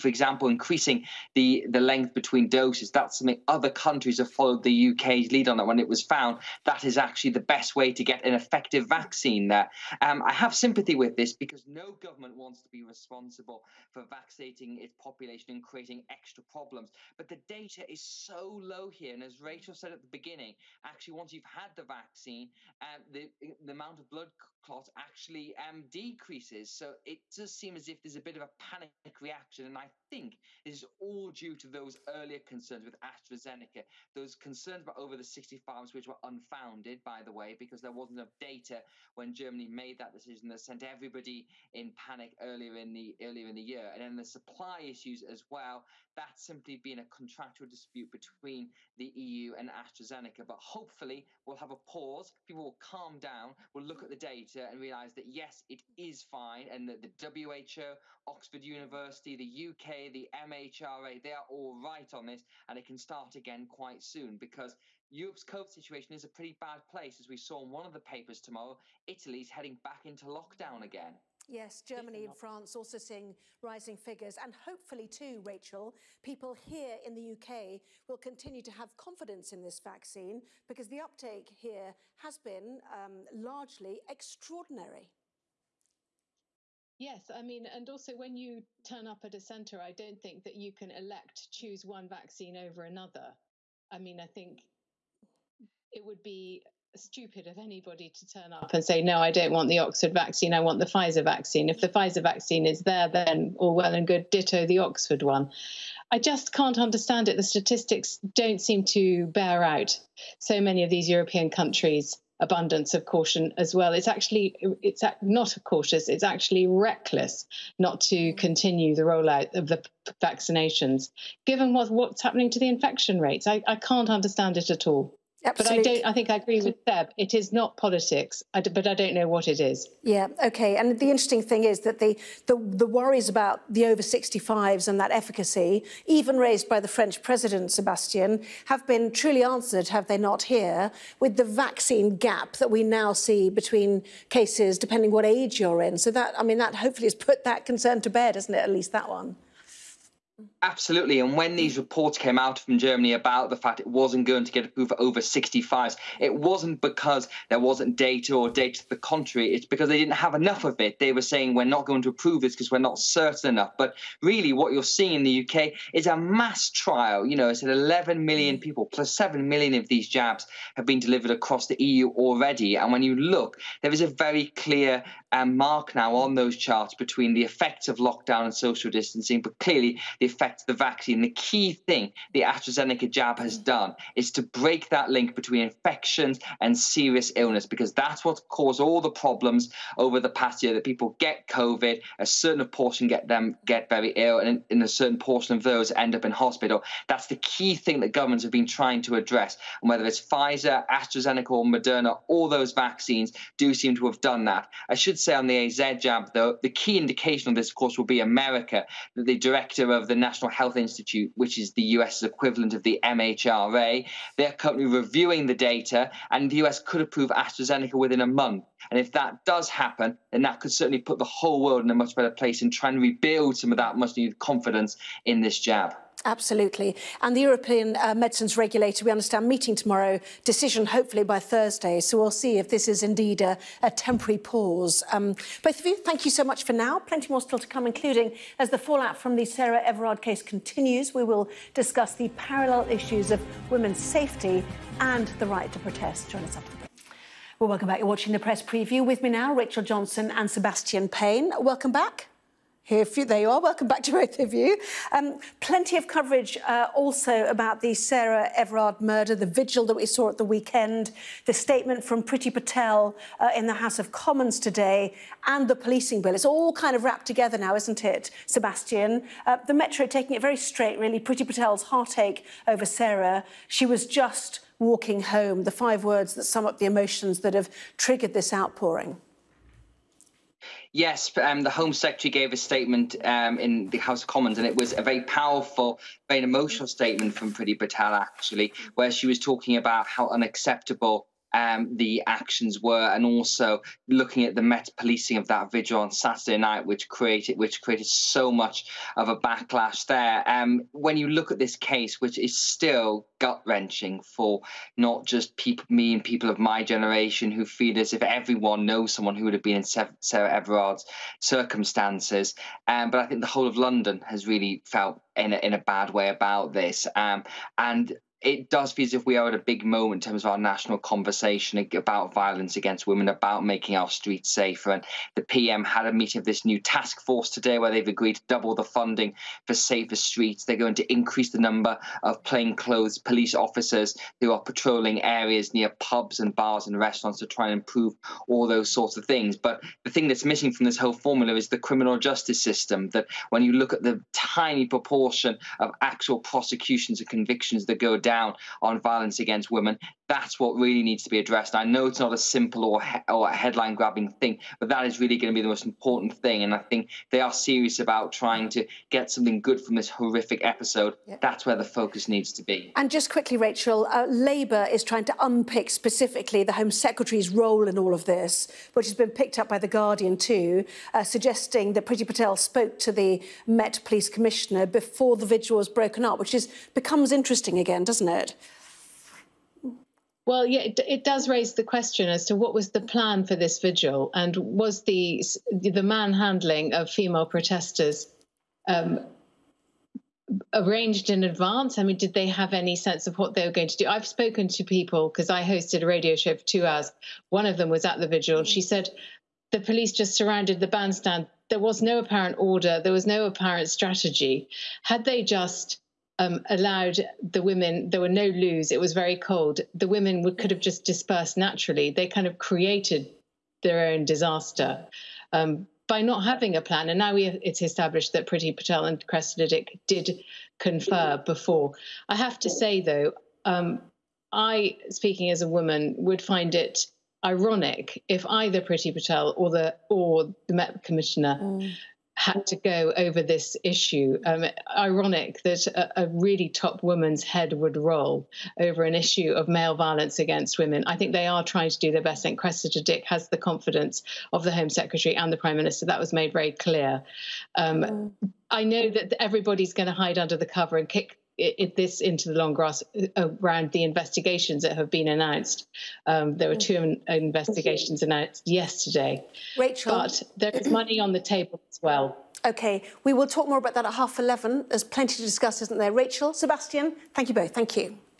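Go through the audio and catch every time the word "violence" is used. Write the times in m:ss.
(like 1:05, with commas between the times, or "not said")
5:22, 5:49, 7:19.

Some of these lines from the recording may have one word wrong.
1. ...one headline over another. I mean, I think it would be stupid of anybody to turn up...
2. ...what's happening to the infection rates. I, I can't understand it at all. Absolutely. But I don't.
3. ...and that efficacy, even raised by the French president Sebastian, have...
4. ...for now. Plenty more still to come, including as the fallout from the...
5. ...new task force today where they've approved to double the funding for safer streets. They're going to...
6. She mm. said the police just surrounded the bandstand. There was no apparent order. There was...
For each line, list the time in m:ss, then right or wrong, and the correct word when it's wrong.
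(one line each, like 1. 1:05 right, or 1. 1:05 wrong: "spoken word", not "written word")
1. 1:31 wrong: "vaccine", not "headline"
2. 2:01 right
3. 2:14 right
4. 3:56 right
5. 5:26 wrong: "agreed", not "approved"
6. 6:38 right.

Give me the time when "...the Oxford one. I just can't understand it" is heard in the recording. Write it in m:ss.
1:44.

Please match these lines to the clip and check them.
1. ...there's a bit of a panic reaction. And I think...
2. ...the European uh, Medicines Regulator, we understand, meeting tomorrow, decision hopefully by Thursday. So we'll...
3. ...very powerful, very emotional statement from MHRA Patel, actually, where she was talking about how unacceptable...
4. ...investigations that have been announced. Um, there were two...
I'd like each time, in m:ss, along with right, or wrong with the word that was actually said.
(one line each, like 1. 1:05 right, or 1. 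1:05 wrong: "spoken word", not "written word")
1. 0:28 right
2. 3:47 right
3. 4:45 wrong: "Priti", not "MHRA"
4. 7:34 right.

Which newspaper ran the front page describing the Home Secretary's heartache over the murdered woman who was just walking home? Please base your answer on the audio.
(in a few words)
The Metro.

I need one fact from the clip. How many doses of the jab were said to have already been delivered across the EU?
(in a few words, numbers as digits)
7 million.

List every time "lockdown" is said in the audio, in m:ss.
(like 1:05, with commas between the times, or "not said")
1:10, 2:57.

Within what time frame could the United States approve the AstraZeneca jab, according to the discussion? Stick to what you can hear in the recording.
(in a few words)
within a month.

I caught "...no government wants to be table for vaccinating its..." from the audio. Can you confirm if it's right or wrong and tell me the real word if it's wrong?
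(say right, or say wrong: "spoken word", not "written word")
wrong: "responsible", not "table".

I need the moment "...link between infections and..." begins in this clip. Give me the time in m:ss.
3:05.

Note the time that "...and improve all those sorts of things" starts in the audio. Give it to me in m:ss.
5:37.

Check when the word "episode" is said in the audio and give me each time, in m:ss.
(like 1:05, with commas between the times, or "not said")
6:00.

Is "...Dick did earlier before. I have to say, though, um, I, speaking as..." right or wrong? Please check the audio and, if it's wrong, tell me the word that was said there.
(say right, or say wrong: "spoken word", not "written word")
wrong: "confer", not "earlier".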